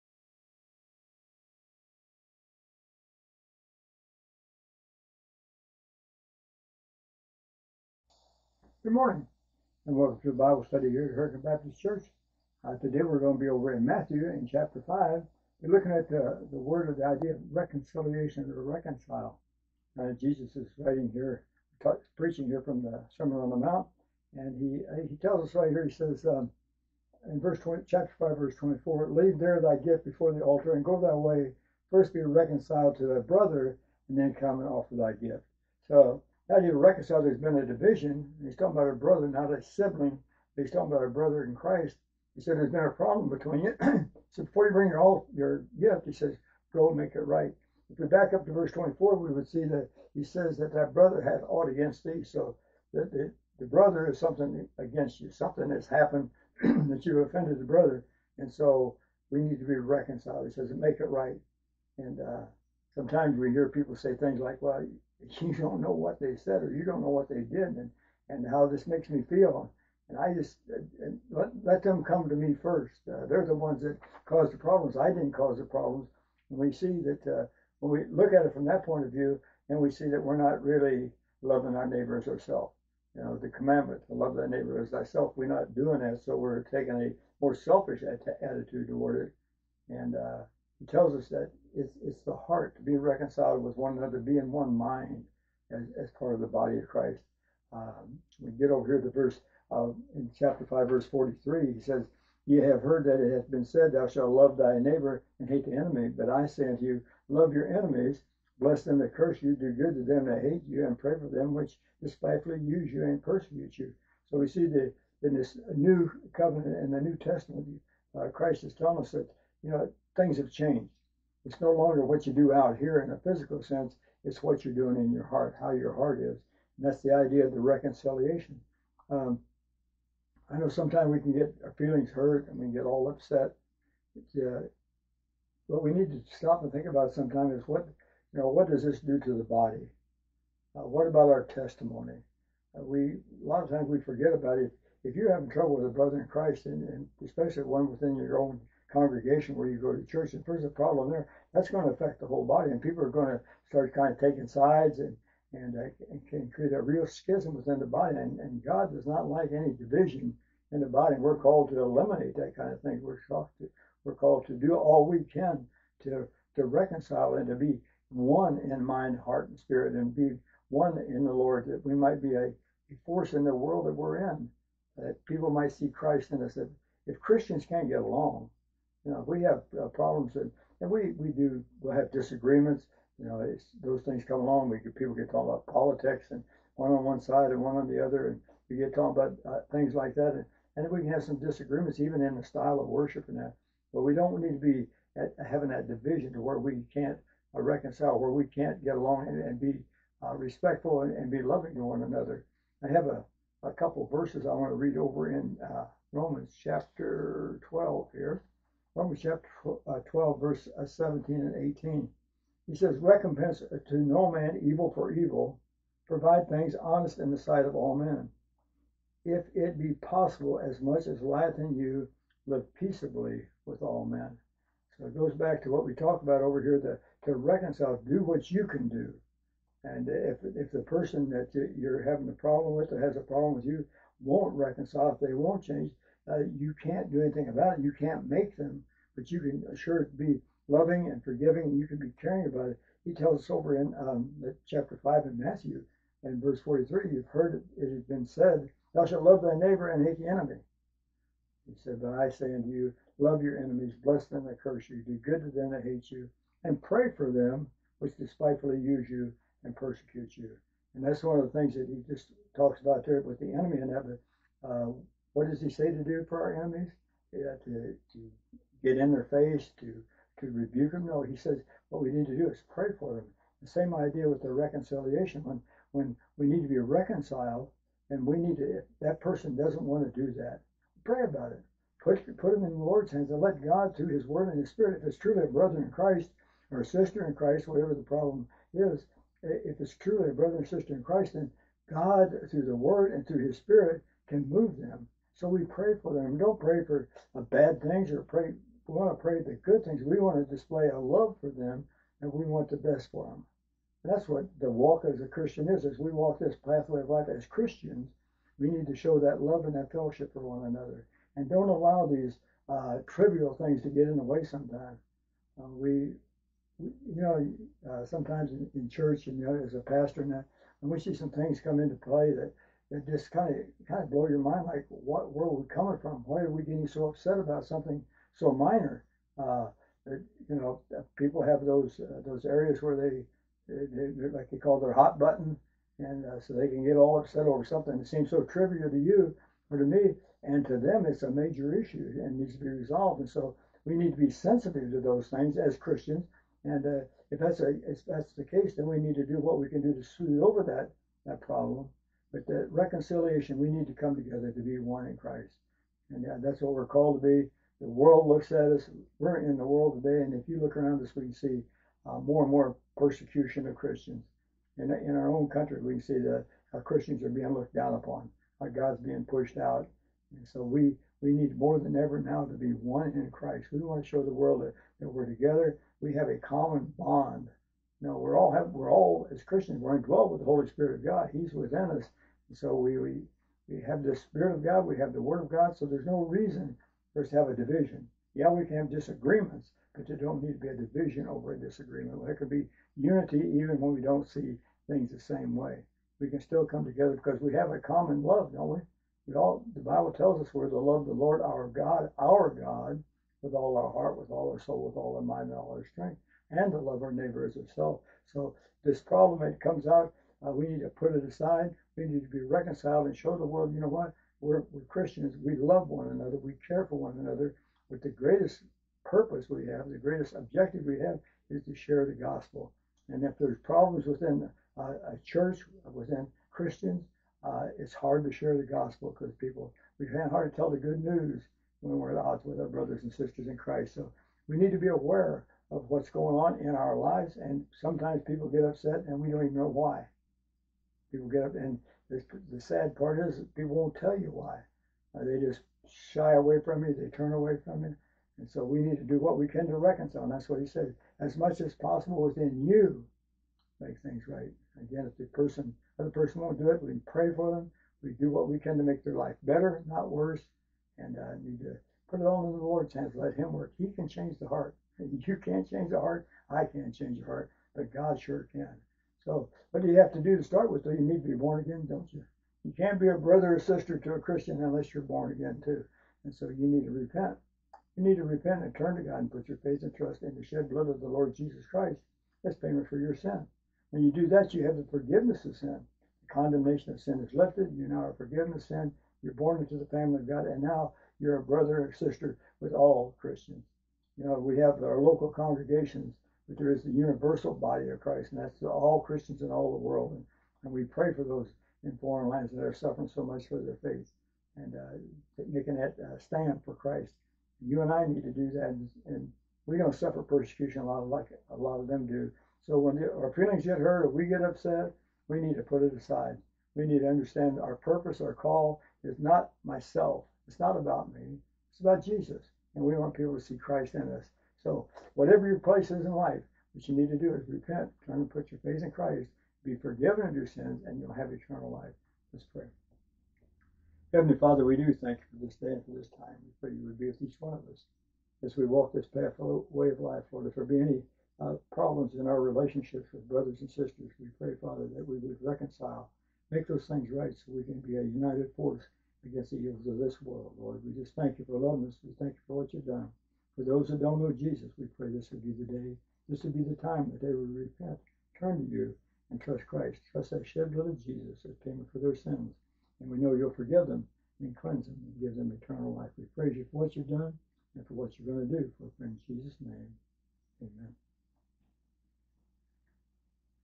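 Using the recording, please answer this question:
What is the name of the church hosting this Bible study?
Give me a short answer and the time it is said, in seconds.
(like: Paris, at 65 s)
Hurricane Baptist Church, at 11 s.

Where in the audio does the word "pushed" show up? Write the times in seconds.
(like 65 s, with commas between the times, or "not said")
369 s.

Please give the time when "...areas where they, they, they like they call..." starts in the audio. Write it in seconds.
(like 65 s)
332 s.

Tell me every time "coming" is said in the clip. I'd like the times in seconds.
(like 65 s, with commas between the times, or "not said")
325 s.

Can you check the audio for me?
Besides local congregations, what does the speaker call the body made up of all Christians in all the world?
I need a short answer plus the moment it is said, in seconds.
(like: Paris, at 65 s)
universal body of Christ, at 496 s.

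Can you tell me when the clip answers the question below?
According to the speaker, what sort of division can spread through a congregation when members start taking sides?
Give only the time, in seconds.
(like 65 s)
157 s.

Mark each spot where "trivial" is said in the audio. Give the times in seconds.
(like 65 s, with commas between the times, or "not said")
313 s, 338 s.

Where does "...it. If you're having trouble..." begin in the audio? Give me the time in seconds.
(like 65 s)
144 s.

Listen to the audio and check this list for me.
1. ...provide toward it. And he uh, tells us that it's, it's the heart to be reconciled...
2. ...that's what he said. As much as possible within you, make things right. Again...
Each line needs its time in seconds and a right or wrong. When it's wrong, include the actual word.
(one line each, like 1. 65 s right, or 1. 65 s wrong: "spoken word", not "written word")
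1. 88 s wrong: "attitude", not "provide"
2. 450 s right.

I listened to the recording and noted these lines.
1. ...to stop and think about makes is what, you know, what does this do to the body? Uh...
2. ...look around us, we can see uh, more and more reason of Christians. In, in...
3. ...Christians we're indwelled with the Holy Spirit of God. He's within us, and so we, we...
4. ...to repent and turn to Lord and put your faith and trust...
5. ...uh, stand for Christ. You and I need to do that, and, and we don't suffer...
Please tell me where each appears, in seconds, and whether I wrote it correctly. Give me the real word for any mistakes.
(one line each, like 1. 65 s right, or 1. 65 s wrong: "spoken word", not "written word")
1. 136 s wrong: "sometimes", not "makes"
2. 360 s wrong: "persecution", not "reason"
3. 379 s right
4. 478 s wrong: "God", not "Lord"
5. 505 s right.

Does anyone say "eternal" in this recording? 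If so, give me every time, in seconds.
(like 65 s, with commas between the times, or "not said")
531 s, 565 s.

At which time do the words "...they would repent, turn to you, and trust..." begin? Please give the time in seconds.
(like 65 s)
557 s.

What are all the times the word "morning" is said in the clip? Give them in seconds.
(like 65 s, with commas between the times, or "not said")
8 s.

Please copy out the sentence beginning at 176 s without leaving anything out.
That if Christians can't get along, you know, we have uh, problems and, and we, we do, we'll have disagreements.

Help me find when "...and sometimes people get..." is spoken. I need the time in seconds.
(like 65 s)
437 s.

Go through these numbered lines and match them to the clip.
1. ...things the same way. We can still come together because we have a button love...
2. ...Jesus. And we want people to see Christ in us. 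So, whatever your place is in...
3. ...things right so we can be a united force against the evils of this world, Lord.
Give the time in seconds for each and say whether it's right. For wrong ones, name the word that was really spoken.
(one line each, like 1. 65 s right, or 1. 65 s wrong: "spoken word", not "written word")
1. 394 s wrong: "common", not "button"
2. 522 s right
3. 546 s right.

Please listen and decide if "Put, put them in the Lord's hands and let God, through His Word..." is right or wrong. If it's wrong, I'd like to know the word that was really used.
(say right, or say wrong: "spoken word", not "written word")
right.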